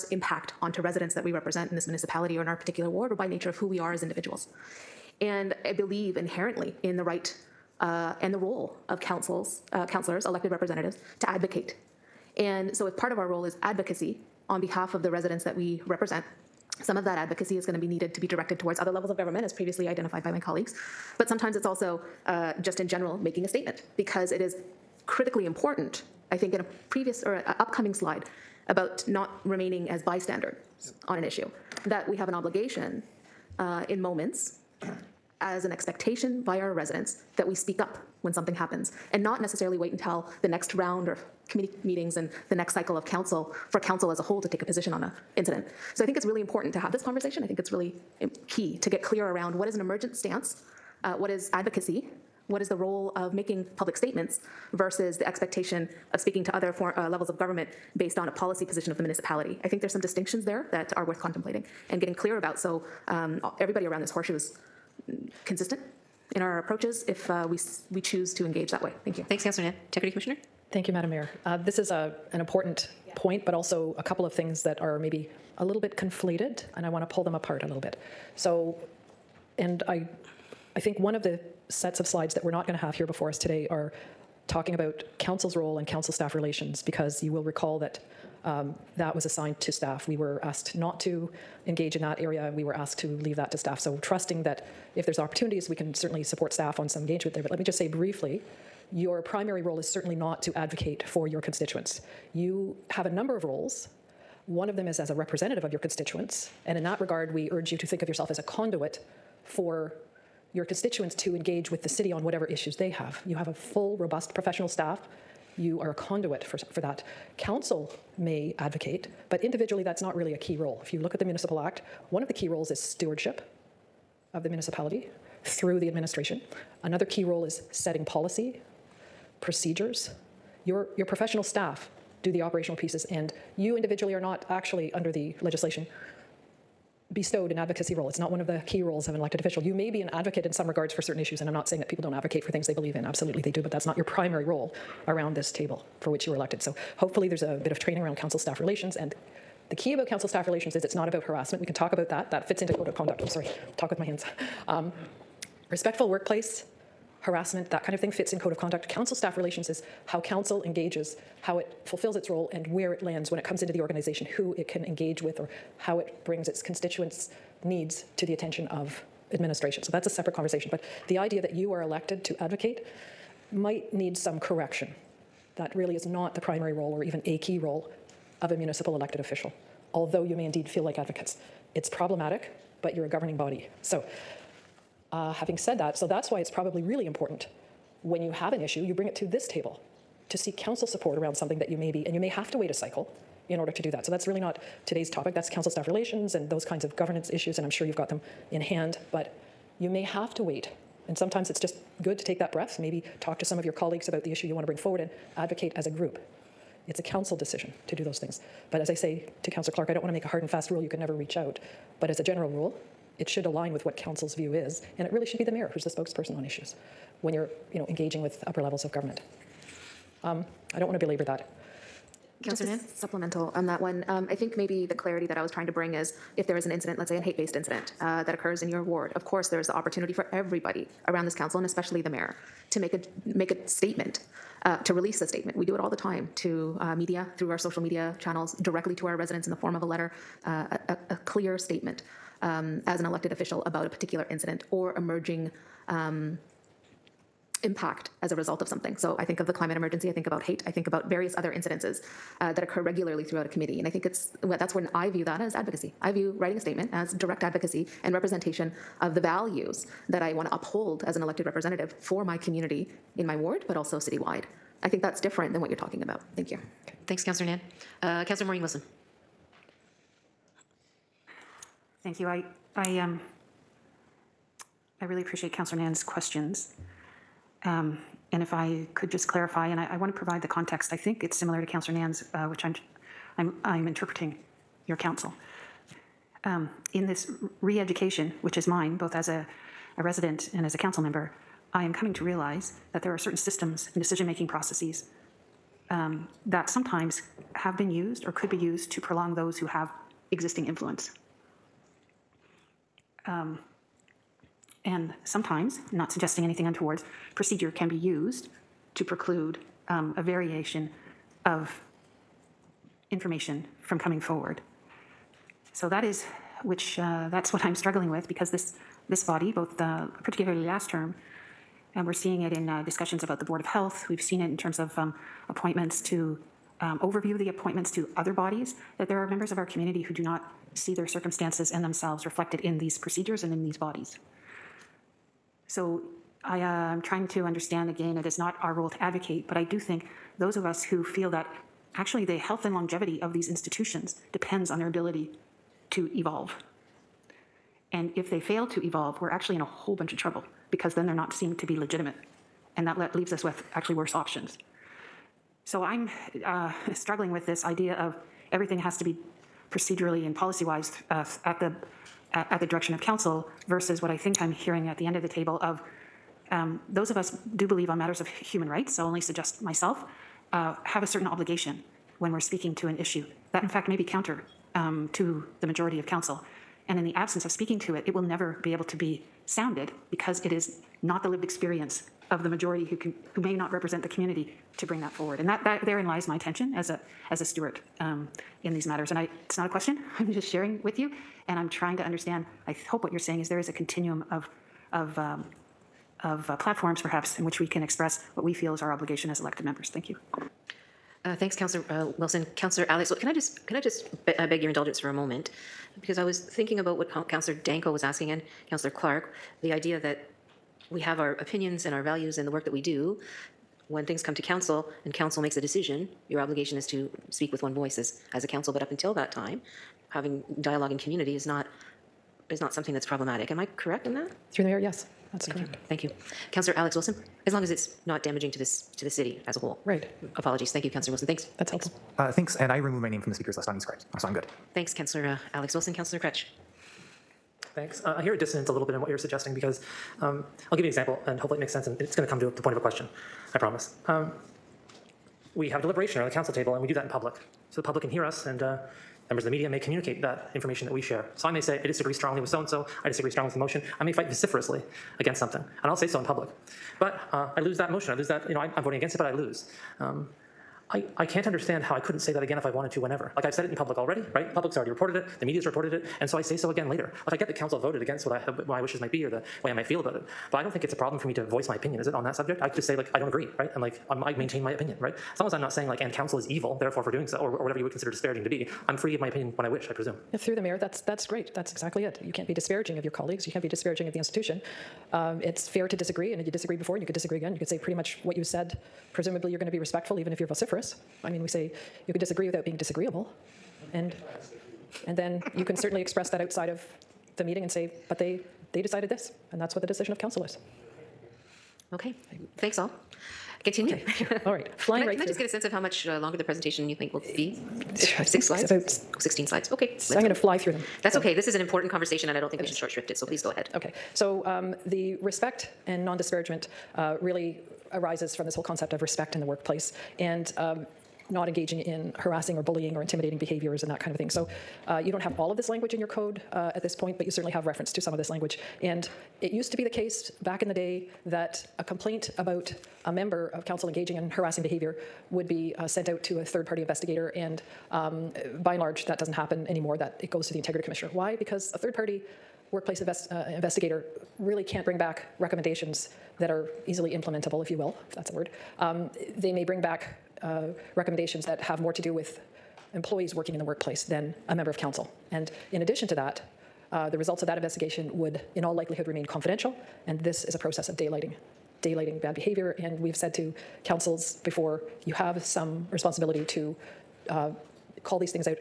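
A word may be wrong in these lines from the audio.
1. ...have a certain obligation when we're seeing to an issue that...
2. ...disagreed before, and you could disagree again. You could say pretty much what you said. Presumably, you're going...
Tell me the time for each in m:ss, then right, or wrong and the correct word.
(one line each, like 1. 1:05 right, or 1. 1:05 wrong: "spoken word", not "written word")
1. 6:10 wrong: "speaking", not "seeing"
2. 8:06 right.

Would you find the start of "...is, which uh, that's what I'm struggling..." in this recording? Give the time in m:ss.
5:16.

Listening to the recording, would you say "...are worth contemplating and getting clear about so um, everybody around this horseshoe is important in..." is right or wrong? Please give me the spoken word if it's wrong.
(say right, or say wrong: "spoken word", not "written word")
wrong: "consistent", not "important".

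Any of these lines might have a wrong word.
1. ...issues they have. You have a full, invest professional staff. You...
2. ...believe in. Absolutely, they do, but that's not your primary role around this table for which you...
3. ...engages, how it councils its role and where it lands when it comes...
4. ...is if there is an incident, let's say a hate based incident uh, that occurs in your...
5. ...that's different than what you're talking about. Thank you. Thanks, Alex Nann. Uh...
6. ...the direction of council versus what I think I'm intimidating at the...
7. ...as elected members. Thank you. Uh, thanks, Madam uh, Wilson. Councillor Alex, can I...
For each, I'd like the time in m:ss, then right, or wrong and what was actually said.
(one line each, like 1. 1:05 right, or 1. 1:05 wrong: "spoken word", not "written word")
1. 1:52 wrong: "robust", not "invest"
2. 2:22 right
3. 2:40 wrong: "fulfills", not "councils"
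4. 3:45 right
5. 4:25 wrong: "Councillor", not "Alex"
6. 6:02 wrong: "hearing", not "intimidating"
7. 6:39 wrong: "Councillor", not "Madam".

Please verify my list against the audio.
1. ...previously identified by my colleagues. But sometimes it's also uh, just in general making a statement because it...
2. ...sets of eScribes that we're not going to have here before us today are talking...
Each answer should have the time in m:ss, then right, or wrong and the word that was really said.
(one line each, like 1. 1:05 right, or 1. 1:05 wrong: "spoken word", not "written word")
1. 0:19 right
2. 1:21 wrong: "slides", not "eScribes".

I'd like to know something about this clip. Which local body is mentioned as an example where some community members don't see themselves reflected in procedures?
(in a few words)
Board of Health.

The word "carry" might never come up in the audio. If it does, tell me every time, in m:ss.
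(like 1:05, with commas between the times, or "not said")
not said.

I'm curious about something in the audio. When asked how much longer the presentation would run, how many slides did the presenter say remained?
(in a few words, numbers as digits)
16.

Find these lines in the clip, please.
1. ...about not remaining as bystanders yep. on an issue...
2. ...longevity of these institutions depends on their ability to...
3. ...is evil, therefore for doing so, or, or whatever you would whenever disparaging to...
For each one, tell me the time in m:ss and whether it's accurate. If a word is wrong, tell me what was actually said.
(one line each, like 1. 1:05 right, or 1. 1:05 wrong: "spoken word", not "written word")
1. 0:28 right
2. 5:42 right
3. 7:56 wrong: "consider", not "whenever".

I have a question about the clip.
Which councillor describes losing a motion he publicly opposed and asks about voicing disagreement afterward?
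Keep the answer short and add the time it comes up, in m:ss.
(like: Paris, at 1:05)
Kroetsch, at 7:16.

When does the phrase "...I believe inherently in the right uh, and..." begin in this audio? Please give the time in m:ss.
0:05.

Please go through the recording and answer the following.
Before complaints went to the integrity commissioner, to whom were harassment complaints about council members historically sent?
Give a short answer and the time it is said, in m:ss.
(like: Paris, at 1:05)
third party investigator, at 8:56.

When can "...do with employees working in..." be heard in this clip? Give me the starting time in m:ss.
9:12.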